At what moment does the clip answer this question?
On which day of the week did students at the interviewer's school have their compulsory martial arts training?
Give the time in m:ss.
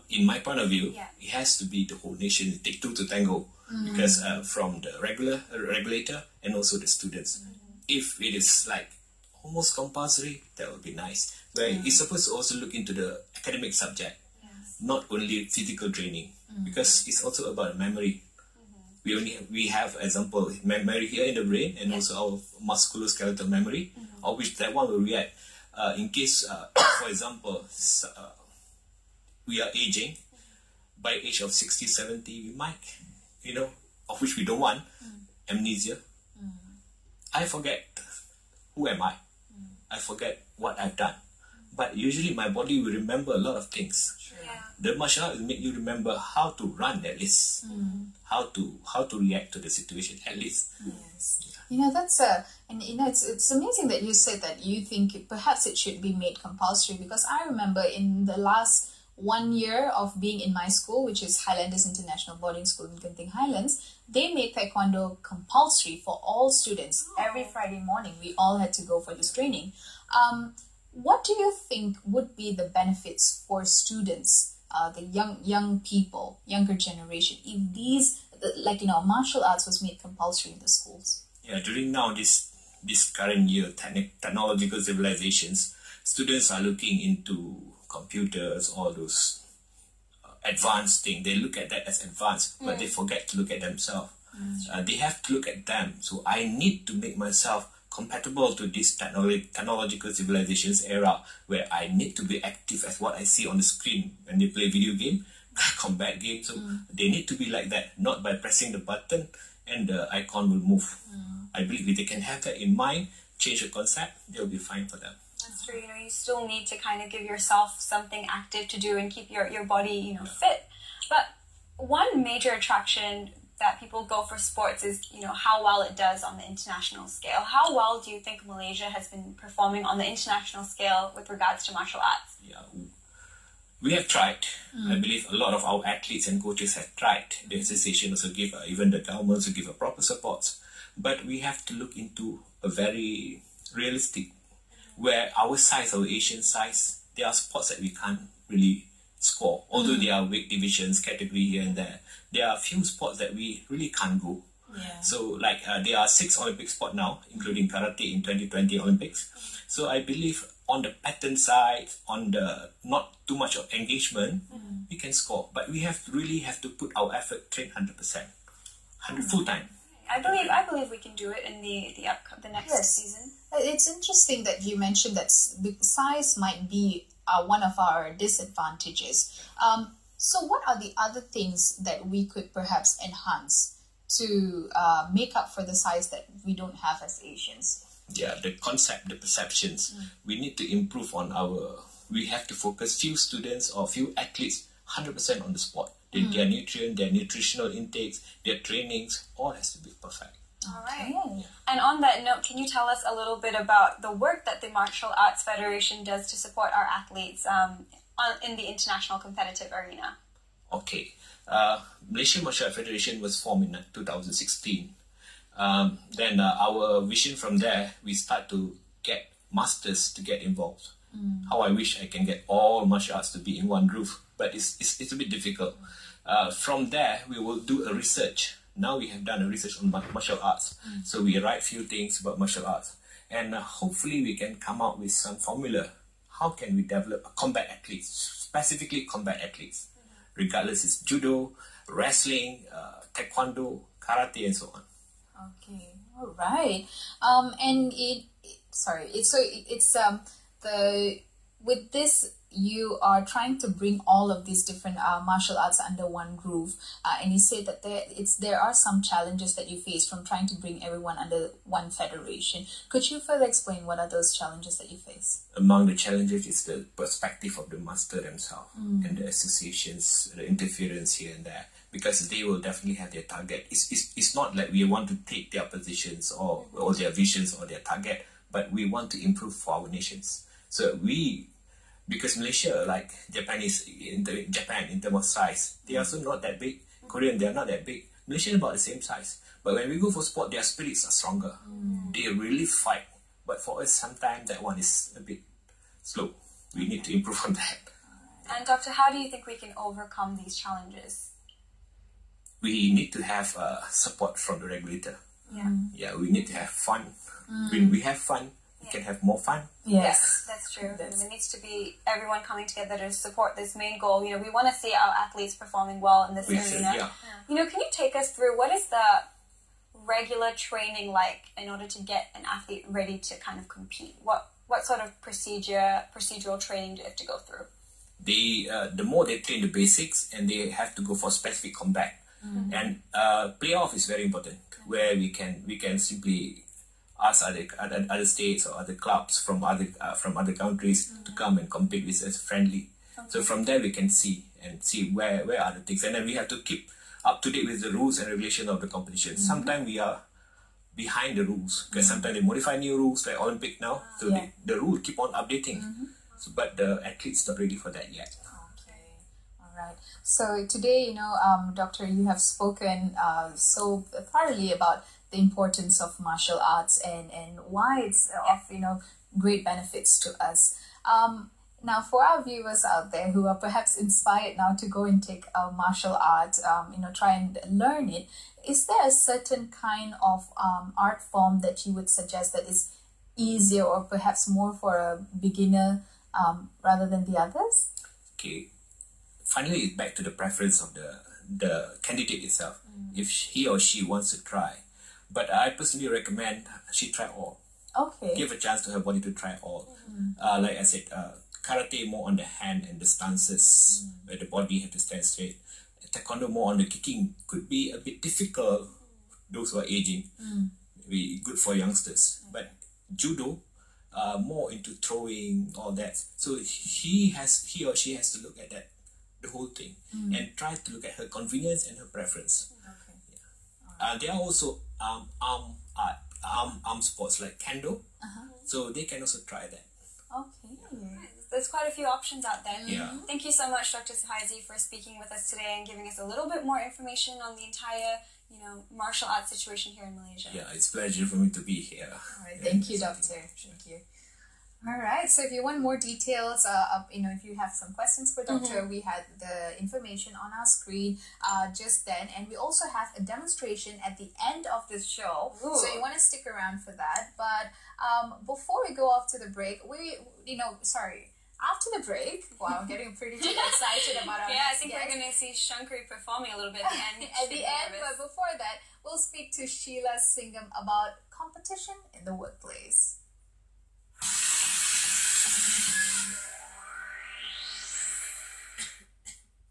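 1:07.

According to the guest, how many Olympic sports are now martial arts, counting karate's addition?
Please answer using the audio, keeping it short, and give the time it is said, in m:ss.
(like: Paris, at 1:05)
6, at 2:36.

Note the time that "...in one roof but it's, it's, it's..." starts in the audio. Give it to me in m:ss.
3:43.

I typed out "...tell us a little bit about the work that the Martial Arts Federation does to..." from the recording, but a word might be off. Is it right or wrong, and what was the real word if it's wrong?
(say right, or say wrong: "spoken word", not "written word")
right.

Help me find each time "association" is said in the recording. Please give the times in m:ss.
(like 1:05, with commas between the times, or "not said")
2:17, 4:29.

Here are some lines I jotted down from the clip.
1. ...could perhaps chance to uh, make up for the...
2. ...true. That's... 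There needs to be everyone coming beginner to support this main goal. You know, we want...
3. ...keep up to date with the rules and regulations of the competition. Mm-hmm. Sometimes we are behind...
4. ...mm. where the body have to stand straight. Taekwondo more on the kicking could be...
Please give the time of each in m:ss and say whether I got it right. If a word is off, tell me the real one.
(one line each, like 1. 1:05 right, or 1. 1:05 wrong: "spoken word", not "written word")
1. 3:02 wrong: "enhance", not "chance"
2. 5:10 wrong: "together", not "beginner"
3. 5:46 right
4. 6:44 right.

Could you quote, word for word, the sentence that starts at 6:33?
If he or she wants to try, but I personally recommend she try all.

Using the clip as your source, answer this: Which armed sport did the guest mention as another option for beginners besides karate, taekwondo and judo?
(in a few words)
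Kendo.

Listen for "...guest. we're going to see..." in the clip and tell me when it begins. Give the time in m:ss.
7:44.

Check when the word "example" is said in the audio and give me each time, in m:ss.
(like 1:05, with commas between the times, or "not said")
0:20, 0:27.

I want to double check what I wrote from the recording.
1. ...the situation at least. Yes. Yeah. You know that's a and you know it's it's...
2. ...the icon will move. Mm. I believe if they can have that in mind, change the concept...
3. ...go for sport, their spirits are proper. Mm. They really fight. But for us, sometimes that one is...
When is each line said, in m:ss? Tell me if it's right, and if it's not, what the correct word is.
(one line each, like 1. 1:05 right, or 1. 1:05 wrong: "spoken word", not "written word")
1. 0:49 right
2. 1:49 right
3. 4:49 wrong: "stronger", not "proper".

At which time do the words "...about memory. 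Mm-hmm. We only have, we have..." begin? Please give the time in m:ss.
0:17.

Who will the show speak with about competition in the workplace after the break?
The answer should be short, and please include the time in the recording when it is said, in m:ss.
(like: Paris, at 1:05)
Sheila Singham, at 7:49.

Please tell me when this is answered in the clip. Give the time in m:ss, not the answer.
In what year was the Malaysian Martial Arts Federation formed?
3:33.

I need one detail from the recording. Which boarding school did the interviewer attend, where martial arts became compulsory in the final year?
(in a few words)
Highlanders International Boarding School.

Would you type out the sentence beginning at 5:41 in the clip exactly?
come and compete with us friendly.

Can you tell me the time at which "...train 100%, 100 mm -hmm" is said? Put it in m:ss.
2:47.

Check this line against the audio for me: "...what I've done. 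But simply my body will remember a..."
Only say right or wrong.
wrong.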